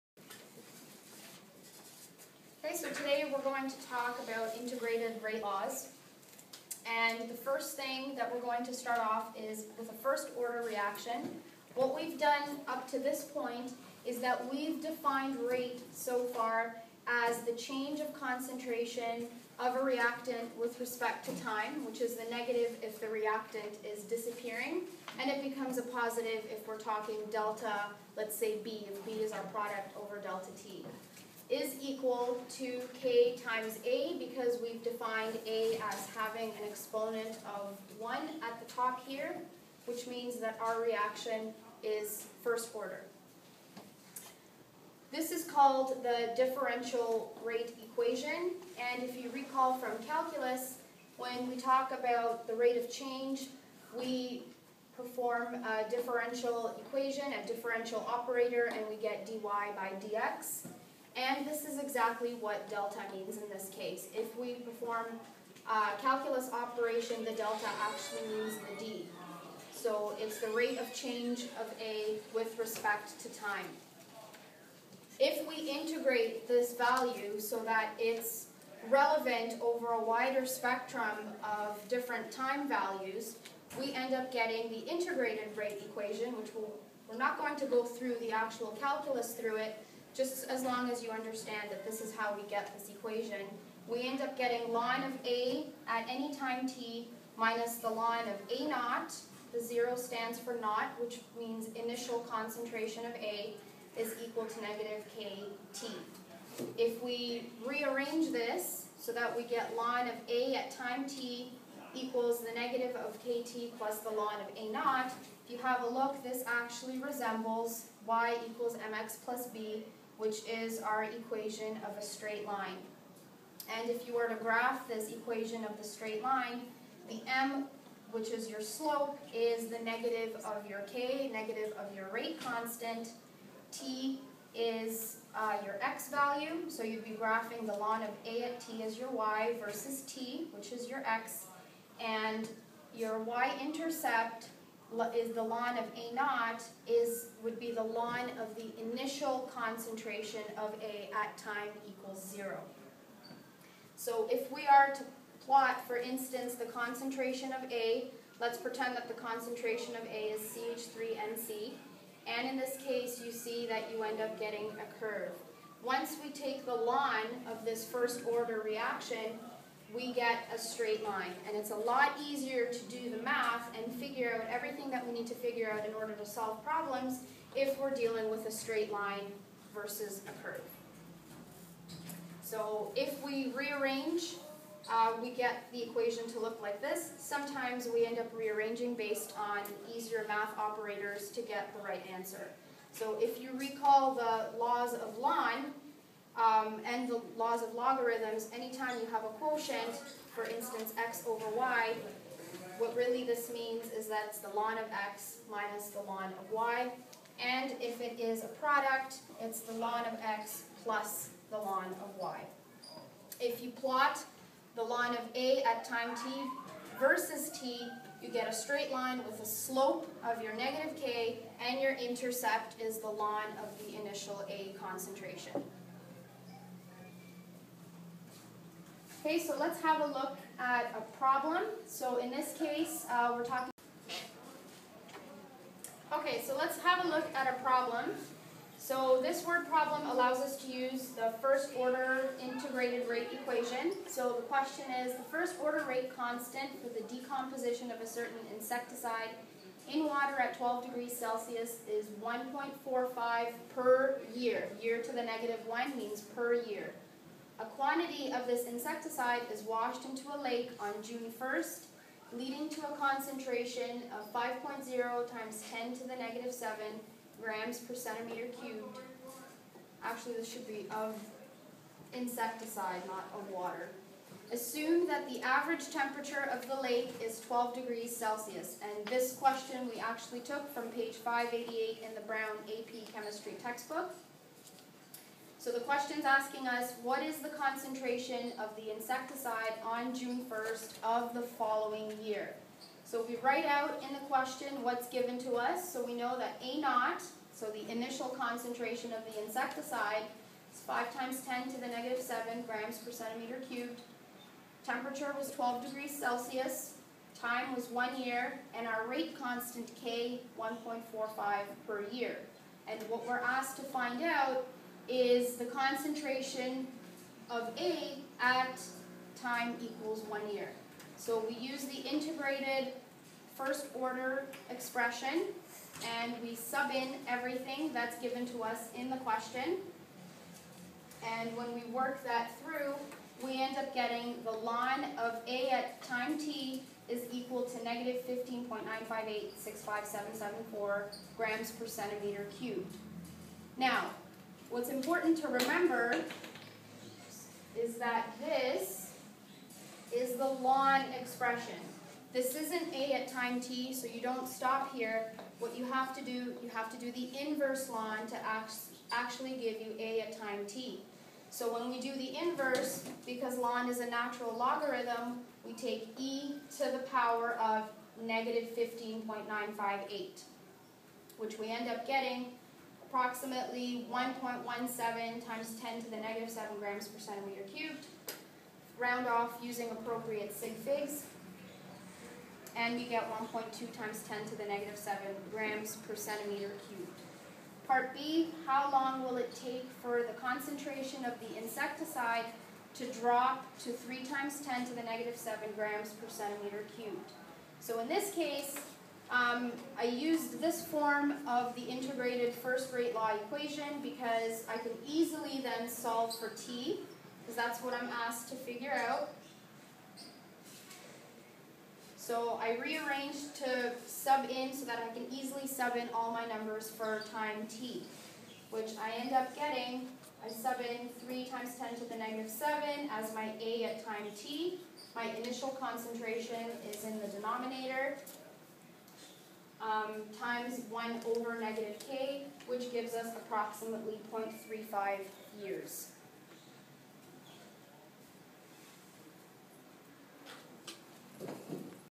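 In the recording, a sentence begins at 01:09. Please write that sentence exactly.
So it's the rate of change of a with respect to time.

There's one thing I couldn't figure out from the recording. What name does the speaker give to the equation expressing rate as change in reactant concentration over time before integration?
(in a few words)
differential rate equation.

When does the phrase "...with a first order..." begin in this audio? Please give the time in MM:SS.
00:09.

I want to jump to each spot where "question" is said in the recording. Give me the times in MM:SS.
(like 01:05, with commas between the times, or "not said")
04:04, 04:39, 04:45, 04:54, 05:29.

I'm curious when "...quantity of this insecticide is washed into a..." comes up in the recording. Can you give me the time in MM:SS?
04:17.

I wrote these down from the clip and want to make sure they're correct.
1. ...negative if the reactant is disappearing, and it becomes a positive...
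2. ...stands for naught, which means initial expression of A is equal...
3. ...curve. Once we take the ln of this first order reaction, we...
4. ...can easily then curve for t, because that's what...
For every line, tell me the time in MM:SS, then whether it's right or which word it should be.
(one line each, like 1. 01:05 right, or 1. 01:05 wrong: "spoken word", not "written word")
1. 00:22 right
2. 01:39 wrong: "concentration", not "expression"
3. 02:44 right
4. 06:44 wrong: "solve", not "curve".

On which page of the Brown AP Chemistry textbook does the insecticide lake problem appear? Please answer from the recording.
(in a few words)
588.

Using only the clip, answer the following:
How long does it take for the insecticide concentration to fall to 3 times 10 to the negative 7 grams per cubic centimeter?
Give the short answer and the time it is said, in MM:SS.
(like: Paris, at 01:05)
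0.35 years, at 07:14.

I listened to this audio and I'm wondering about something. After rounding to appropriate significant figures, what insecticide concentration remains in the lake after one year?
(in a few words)
1.2 x 10^-7 g/cm^3.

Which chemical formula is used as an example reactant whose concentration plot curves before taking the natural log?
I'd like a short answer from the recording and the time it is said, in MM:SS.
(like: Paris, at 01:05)
CH3NC, at 02:40.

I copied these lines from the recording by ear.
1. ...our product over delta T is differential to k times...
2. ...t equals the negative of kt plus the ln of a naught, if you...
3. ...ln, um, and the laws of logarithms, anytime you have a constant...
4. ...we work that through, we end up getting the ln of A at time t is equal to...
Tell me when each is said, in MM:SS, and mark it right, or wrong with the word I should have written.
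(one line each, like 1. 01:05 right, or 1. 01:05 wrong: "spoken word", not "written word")
1. 00:29 wrong: "equal", not "differential"
2. 01:51 right
3. 03:15 wrong: "quotient", not "constant"
4. 05:31 right.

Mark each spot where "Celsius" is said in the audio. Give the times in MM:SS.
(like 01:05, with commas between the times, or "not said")
04:11, 04:38, 05:06.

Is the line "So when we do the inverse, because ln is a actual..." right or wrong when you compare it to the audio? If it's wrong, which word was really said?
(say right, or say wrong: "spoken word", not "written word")
wrong: "natural", not "actual".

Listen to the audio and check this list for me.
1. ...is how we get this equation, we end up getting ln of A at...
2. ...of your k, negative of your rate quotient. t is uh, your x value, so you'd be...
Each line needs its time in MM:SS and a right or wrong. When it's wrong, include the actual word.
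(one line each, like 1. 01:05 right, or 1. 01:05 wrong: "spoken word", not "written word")
1. 01:32 right
2. 02:10 wrong: "constant", not "quotient".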